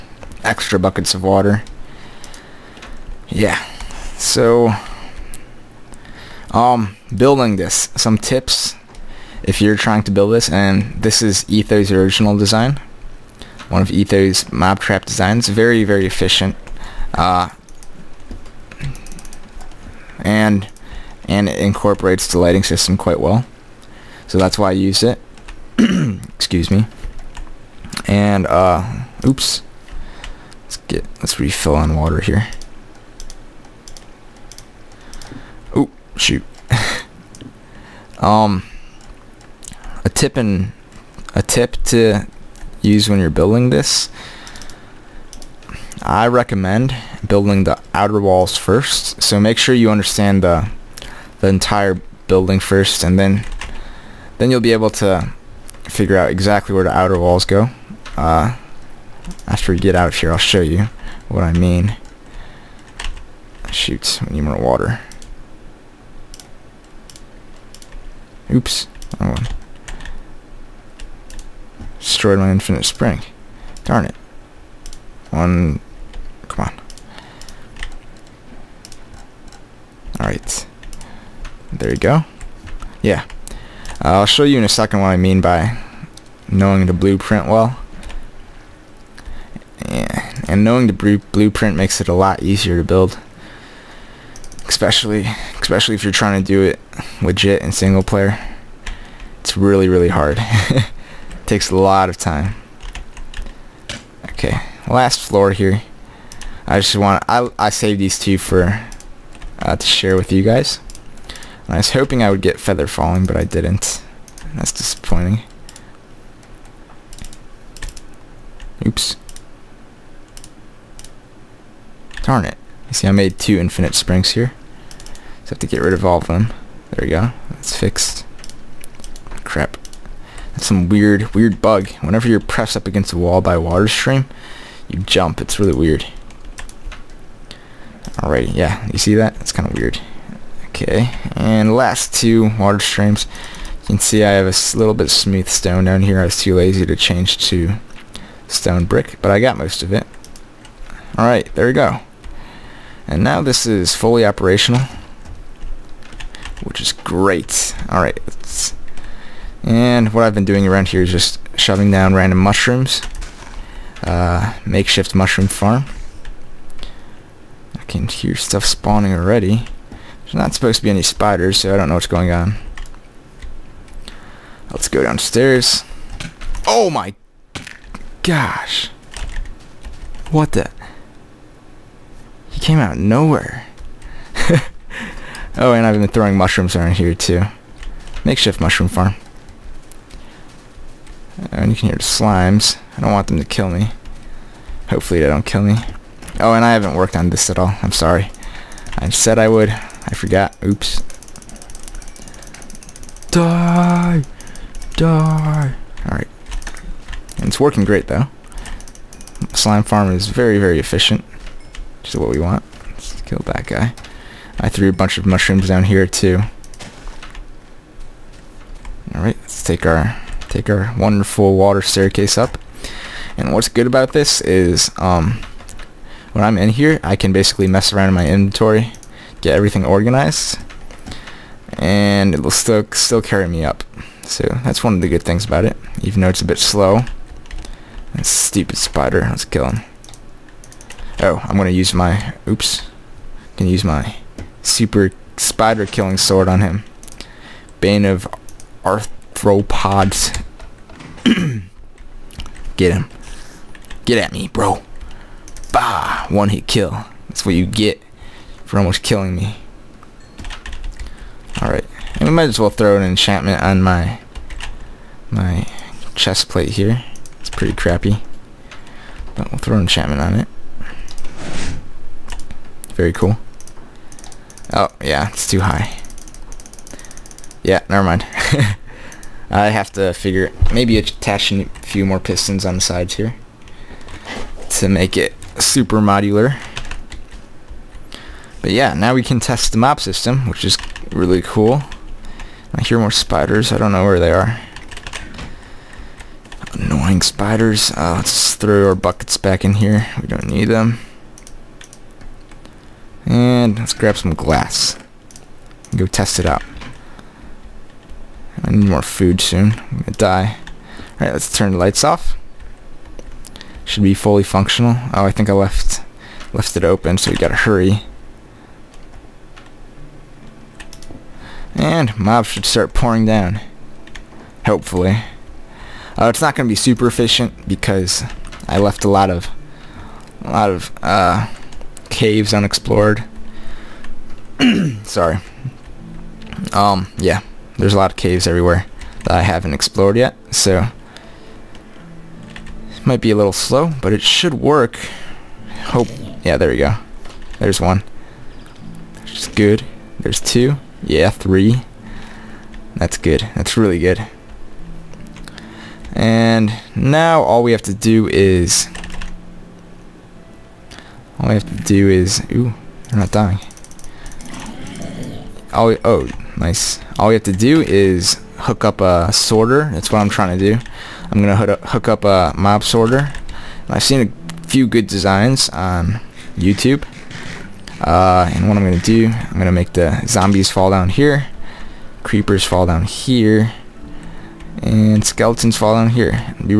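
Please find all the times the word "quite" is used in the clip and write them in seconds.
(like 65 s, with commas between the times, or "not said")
22 s.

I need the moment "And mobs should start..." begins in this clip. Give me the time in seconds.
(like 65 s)
321 s.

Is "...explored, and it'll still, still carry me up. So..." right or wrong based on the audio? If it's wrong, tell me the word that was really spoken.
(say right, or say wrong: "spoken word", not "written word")
wrong: "organized", not "explored".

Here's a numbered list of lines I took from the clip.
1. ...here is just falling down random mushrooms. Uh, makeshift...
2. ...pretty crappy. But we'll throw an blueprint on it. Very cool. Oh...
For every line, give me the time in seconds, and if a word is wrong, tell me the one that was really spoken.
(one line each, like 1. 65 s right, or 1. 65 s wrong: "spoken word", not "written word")
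1. 160 s wrong: "shoving", not "falling"
2. 267 s wrong: "enchantment", not "blueprint".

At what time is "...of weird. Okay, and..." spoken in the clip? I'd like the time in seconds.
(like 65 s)
139 s.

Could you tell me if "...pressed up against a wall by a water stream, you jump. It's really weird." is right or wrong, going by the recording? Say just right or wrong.
right.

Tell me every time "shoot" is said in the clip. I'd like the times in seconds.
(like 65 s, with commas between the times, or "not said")
36 s, 63 s.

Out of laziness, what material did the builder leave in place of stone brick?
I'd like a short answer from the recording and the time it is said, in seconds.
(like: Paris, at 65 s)
Smooth stone, at 145 s.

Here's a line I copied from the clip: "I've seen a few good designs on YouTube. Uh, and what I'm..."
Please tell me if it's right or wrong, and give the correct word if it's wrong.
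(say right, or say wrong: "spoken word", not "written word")
right.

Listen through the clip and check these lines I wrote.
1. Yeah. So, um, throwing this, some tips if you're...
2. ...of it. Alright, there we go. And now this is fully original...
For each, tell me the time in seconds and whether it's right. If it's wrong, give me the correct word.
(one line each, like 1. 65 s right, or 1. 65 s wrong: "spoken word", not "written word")
1. 3 s wrong: "building", not "throwing"
2. 149 s wrong: "operational", not "original".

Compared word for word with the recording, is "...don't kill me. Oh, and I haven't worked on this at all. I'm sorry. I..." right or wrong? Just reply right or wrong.
right.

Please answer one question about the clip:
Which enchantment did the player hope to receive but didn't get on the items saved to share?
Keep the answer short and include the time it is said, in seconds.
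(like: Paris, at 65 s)
Feather falling, at 112 s.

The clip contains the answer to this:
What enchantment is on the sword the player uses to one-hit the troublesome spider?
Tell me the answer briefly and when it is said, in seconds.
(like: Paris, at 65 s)
Bane of arthropods, at 247 s.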